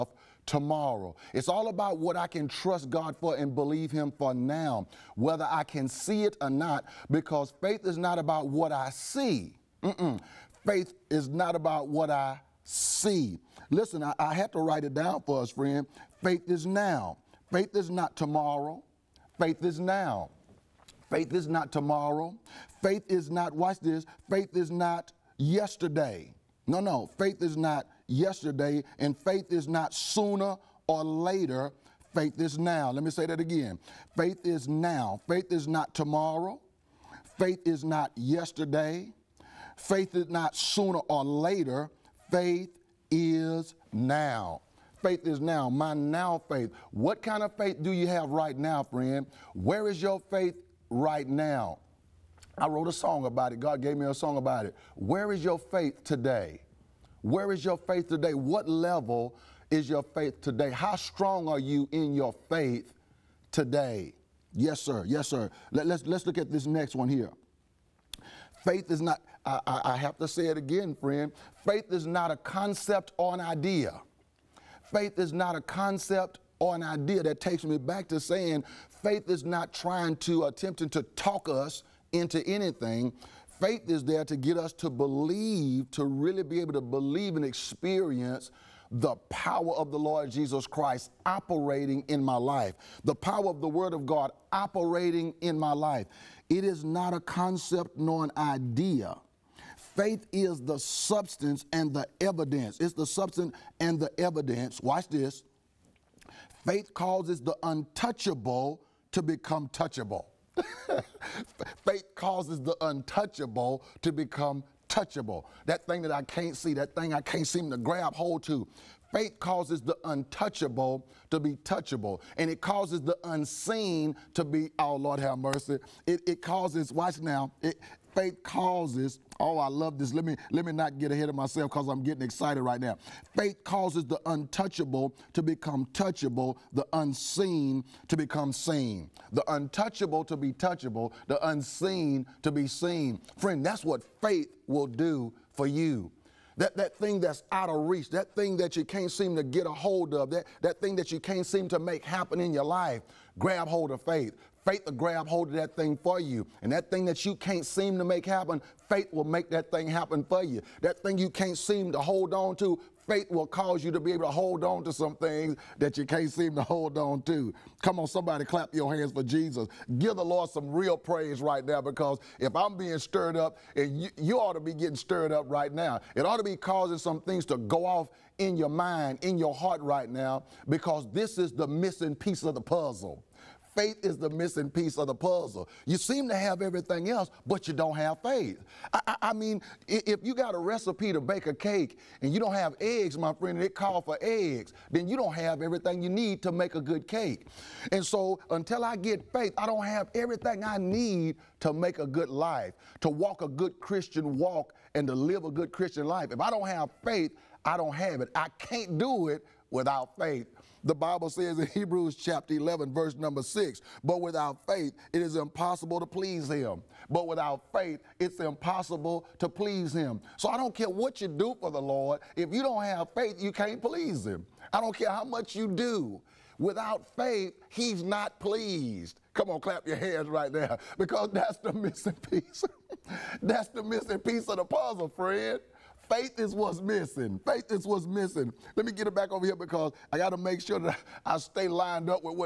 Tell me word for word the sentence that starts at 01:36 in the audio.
It is not a concept nor an idea Faith is the substance and the evidence.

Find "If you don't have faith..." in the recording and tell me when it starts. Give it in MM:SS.
03:42.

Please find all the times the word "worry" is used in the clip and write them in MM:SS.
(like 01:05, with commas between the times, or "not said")
not said.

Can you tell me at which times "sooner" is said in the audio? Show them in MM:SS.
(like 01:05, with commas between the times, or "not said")
00:29, 00:40.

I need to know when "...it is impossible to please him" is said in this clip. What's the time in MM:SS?
03:35.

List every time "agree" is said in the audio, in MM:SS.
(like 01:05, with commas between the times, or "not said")
not said.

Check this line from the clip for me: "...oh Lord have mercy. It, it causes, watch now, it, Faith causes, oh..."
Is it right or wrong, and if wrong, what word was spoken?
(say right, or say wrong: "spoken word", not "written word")
right.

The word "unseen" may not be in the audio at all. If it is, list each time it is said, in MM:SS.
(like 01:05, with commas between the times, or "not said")
02:03, 02:16, 02:21.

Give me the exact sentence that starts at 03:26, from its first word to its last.
If I don't have faith, I don't have it.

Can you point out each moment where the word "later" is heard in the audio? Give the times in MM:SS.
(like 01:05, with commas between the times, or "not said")
00:31, 00:41.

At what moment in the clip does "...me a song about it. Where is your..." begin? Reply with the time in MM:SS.
00:53.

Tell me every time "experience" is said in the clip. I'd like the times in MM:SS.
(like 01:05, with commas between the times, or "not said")
01:27.